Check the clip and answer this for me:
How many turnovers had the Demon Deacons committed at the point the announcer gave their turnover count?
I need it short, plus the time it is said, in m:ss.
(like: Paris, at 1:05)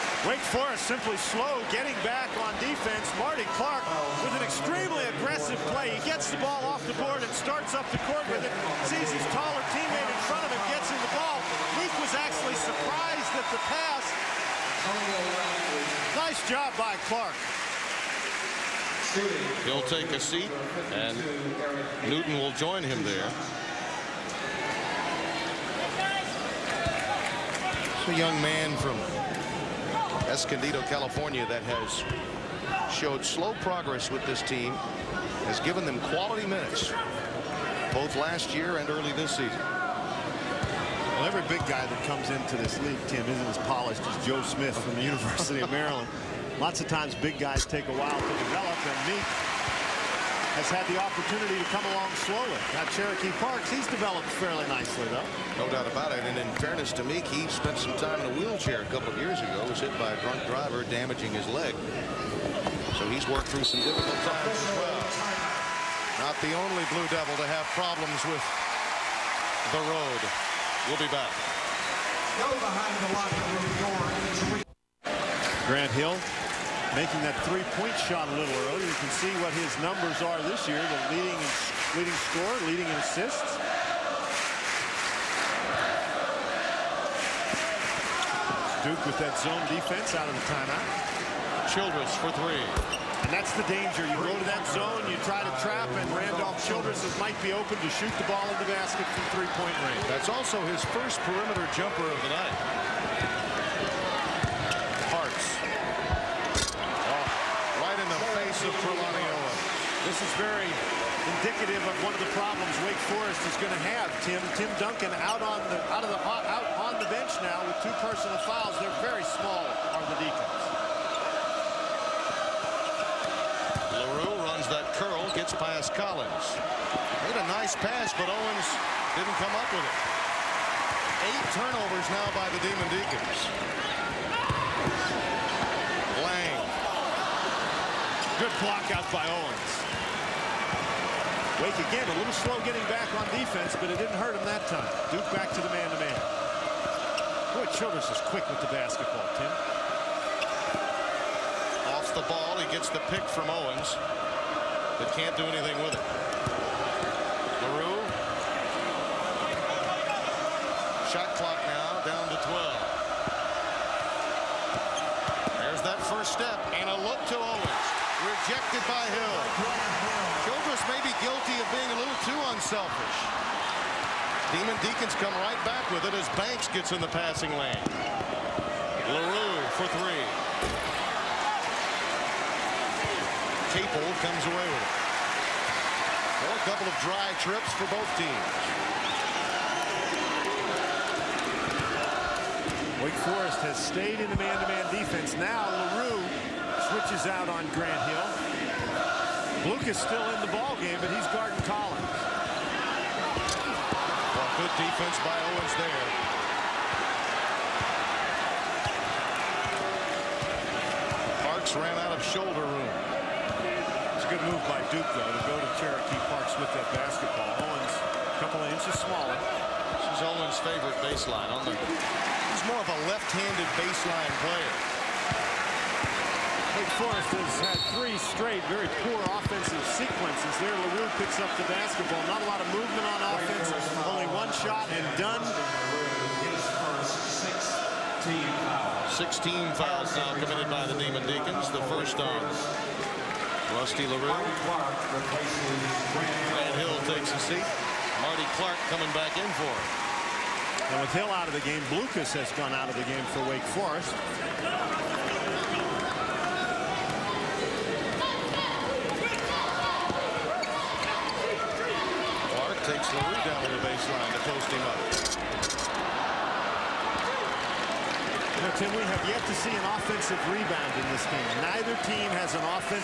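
8, at 2:11.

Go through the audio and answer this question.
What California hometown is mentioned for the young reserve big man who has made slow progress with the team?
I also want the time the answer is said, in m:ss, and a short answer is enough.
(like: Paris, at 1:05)
Escondido, at 0:30.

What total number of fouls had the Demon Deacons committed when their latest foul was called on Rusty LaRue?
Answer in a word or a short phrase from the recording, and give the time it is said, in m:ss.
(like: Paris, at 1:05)
16, at 3:59.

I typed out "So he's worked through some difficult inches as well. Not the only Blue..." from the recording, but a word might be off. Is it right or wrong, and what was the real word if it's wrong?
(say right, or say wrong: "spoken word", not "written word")
wrong: "times", not "inches".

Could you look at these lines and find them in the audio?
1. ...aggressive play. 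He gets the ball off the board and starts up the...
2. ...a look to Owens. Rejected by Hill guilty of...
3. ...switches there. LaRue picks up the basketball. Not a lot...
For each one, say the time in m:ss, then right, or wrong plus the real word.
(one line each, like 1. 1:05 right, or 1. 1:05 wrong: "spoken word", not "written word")
1. 0:05 right
2. 2:46 right
3. 3:49 wrong: "sequences", not "switches".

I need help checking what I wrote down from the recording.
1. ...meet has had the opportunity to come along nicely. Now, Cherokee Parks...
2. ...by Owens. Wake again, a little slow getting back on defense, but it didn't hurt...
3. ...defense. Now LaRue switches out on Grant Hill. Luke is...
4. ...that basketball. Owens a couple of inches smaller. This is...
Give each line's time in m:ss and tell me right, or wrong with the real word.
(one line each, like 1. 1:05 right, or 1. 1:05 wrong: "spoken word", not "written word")
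1. 0:49 wrong: "slowly", not "nicely"
2. 2:19 right
3. 3:14 right
4. 3:36 right.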